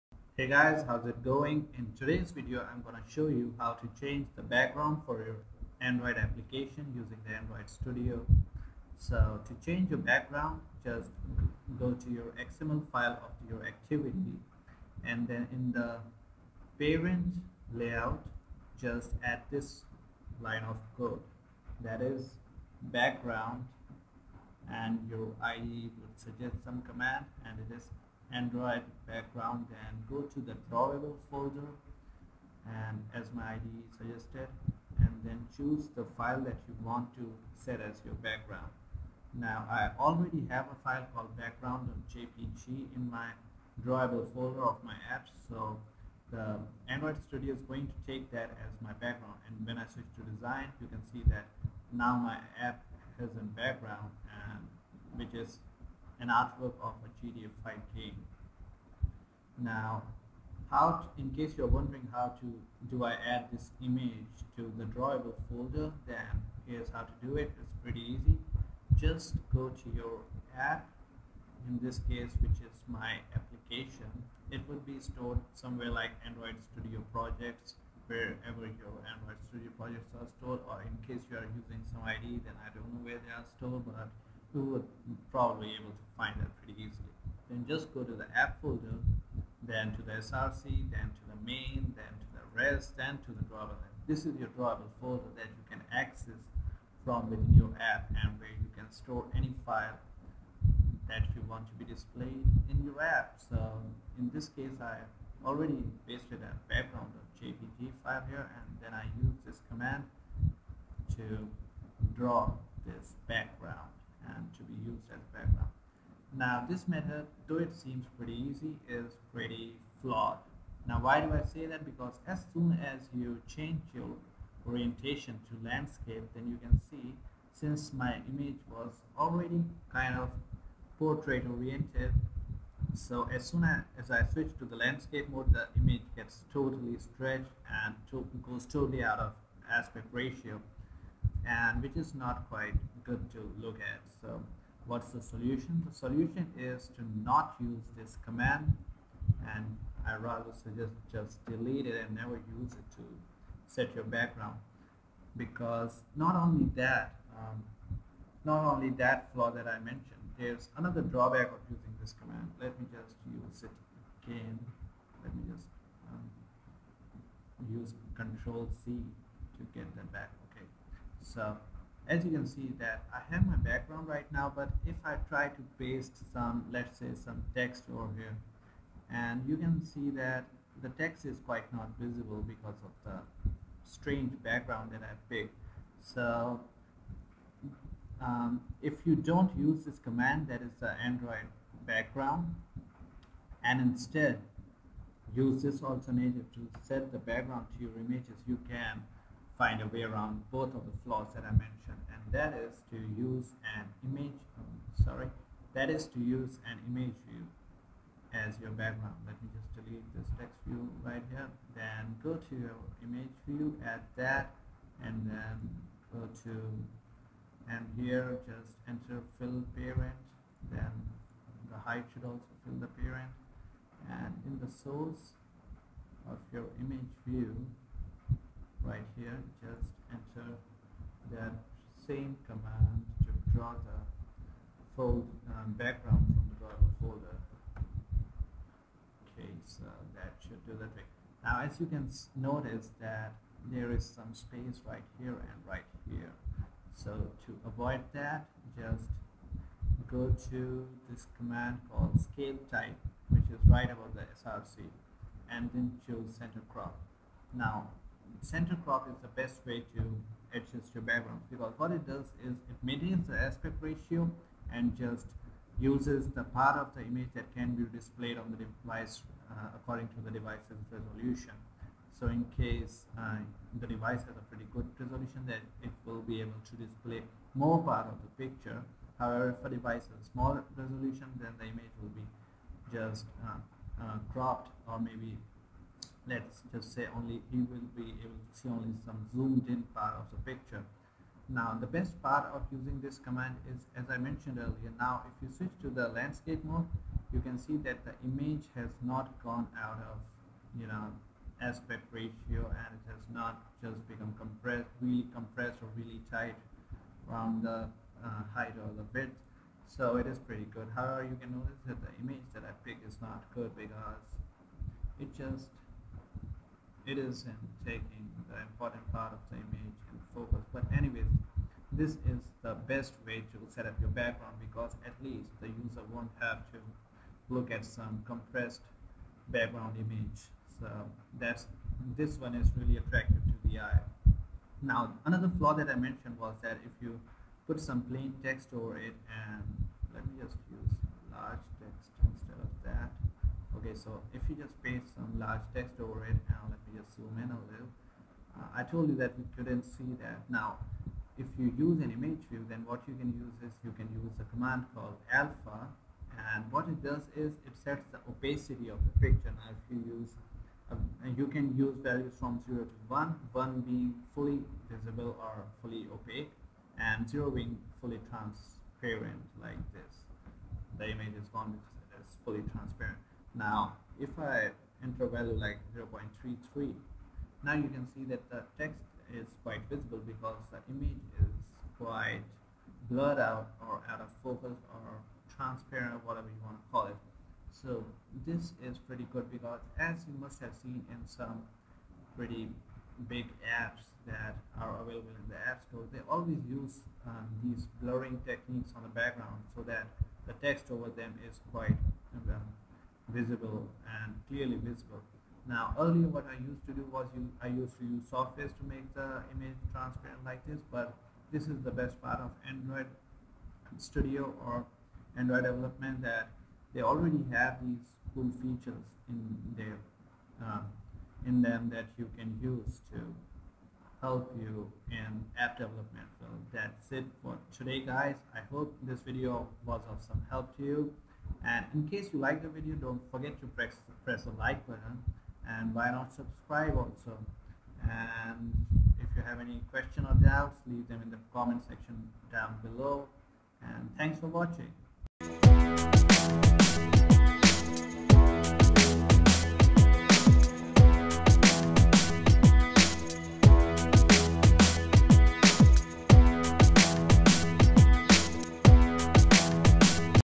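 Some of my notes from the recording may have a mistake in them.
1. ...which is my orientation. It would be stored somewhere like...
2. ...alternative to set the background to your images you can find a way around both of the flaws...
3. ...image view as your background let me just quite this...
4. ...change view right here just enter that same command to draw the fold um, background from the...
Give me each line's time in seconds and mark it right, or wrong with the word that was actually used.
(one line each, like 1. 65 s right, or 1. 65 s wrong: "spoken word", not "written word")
1. 72 s wrong: "application", not "orientation"
2. 195 s right
3. 206 s wrong: "delete", not "quite"
4. 226 s wrong: "image", not "change".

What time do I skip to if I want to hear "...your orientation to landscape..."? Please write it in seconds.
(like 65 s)
123 s.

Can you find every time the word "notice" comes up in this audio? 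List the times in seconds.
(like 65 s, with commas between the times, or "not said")
242 s, 311 s.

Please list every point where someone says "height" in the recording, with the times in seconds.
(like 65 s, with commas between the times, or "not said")
221 s, 308 s.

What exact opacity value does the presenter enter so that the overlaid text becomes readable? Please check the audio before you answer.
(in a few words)
0.33.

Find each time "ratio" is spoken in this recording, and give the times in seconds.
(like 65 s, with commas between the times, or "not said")
140 s, 263 s, 302 s.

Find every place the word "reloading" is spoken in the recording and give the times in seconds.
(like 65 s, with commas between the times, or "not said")
not said.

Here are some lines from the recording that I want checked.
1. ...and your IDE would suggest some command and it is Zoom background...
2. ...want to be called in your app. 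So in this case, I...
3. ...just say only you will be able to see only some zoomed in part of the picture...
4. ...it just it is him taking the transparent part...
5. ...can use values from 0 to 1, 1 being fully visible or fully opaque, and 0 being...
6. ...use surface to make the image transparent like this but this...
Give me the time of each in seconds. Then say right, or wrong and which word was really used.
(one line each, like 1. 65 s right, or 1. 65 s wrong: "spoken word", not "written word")
1. 24 s wrong: "Android", not "Zoom"
2. 101 s wrong: "displayed", not "called"
3. 286 s right
4. 315 s wrong: "important", not "transparent"
5. 361 s right
6. 408 s right.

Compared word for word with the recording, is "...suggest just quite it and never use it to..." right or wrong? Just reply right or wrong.
wrong.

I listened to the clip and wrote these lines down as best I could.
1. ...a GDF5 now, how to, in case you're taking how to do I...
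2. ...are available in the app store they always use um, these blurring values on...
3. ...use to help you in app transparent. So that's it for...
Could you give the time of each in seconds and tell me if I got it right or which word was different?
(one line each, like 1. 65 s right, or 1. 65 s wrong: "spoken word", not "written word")
1. 57 s wrong: "wondering", not "taking"
2. 394 s wrong: "techniques", not "values"
3. 422 s wrong: "development", not "transparent".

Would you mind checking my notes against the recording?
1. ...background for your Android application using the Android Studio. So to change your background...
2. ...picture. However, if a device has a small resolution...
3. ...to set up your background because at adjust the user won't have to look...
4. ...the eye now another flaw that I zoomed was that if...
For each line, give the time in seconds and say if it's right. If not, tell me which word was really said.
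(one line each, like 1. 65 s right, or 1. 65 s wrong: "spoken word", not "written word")
1. 4 s right
2. 278 s right
3. 323 s wrong: "least", not "adjust"
4. 333 s wrong: "mentioned", not "zoomed".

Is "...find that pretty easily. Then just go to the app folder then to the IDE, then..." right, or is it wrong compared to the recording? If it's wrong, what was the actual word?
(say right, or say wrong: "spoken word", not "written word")
wrong: "SRC", not "IDE".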